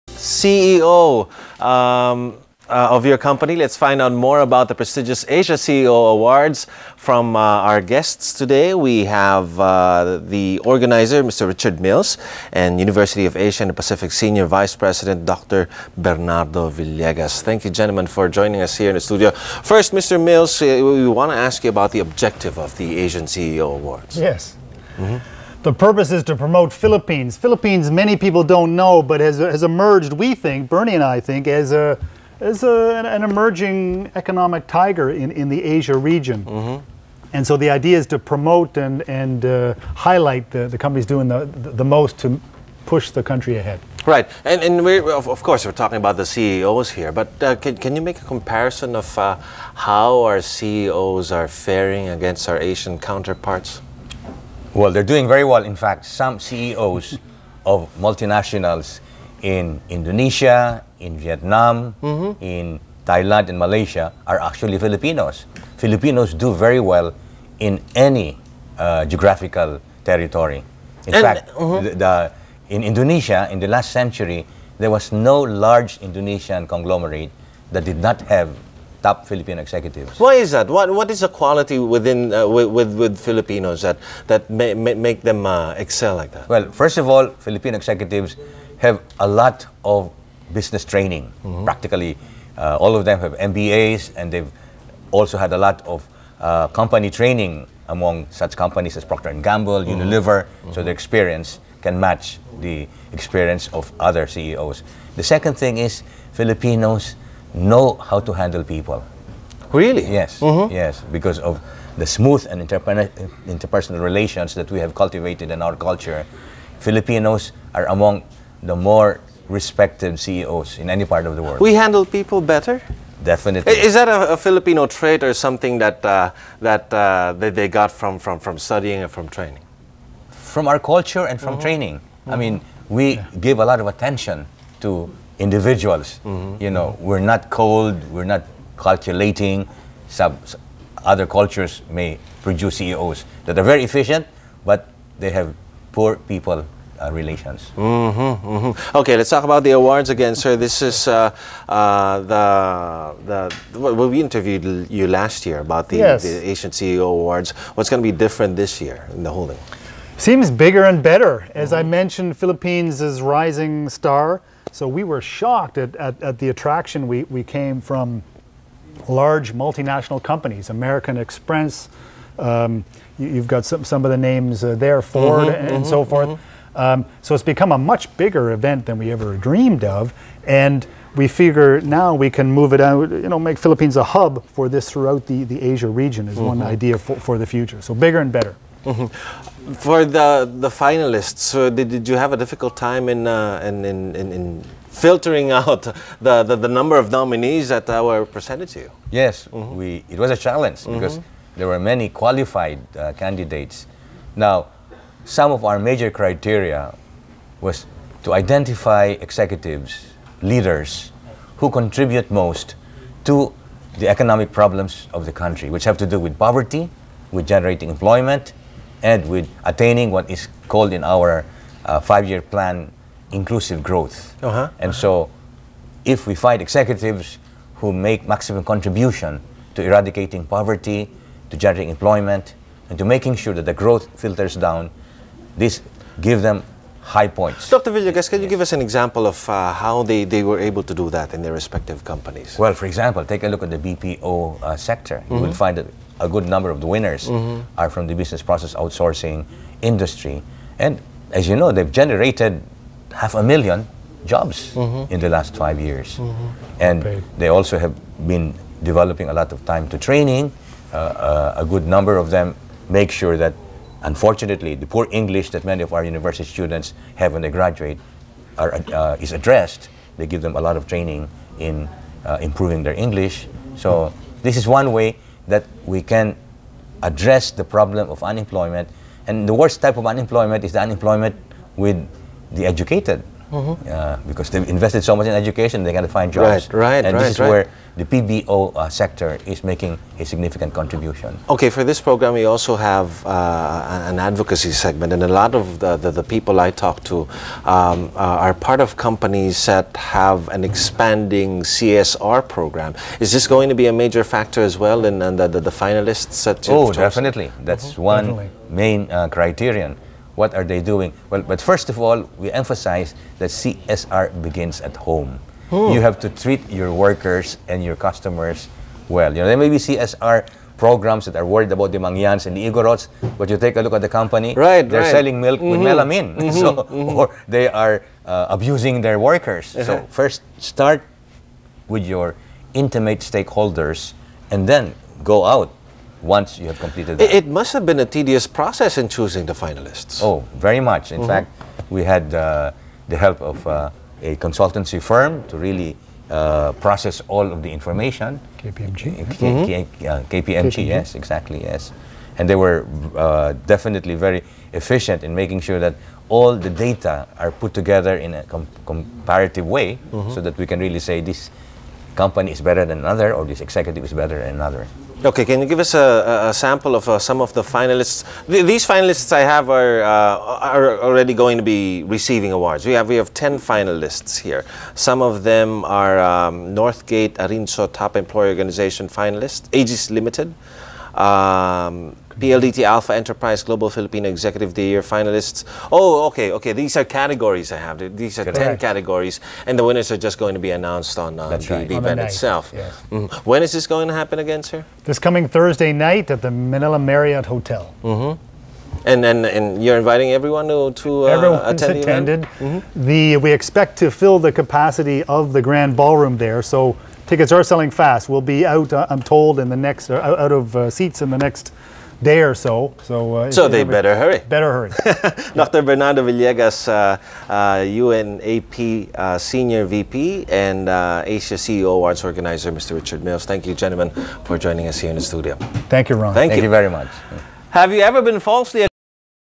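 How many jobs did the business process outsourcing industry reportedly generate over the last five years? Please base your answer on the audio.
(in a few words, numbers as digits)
Half a million.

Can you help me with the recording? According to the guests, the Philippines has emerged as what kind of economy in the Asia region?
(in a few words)
Emerging economic tiger.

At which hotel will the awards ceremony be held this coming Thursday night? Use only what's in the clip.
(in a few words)
Manila Marriott Hotel.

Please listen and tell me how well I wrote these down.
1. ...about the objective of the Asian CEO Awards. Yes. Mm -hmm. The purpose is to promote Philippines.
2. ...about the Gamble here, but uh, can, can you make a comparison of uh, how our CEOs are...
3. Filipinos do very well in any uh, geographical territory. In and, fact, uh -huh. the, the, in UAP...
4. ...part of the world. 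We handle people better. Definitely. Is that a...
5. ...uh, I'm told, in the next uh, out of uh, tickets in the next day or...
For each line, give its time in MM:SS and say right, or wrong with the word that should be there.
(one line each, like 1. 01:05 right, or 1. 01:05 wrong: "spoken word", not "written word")
1. 00:21 right
2. 00:45 wrong: "CEOs", not "Gamble"
3. 01:05 wrong: "Indonesia", not "UAP"
4. 02:01 right
5. 06:48 wrong: "seats", not "tickets".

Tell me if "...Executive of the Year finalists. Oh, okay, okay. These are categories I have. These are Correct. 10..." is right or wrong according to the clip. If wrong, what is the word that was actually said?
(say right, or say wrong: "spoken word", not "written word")
right.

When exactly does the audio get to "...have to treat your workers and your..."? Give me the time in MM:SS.
05:16.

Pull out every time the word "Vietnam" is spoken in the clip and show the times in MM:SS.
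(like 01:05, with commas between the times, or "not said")
01:01.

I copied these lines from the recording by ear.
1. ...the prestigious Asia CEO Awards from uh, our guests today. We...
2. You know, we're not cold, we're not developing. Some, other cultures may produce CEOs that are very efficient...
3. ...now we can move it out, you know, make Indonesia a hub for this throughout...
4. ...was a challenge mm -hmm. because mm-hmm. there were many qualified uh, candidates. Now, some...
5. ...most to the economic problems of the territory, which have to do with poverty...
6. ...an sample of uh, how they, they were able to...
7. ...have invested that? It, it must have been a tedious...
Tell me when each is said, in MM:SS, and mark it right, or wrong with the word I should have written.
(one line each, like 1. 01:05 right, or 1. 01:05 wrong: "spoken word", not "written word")
1. 00:04 right
2. 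02:16 wrong: "calculating", not "developing"
3. 03:01 wrong: "Philippines", not "Indonesia"
4. 03:20 right
5. 03:32 wrong: "country", not "territory"
6. 03:58 wrong: "example", not "sample"
7. 05:36 wrong: "completed", not "invested".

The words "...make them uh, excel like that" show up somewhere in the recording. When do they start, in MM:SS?
01:24.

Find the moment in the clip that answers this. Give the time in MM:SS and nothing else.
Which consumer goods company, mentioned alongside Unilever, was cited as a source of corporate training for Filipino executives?
01:39.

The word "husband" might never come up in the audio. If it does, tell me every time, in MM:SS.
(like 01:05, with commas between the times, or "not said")
not said.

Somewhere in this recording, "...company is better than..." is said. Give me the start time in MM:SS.
06:02.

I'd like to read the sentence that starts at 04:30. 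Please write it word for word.
They give them a lot of training in uh, improving their English.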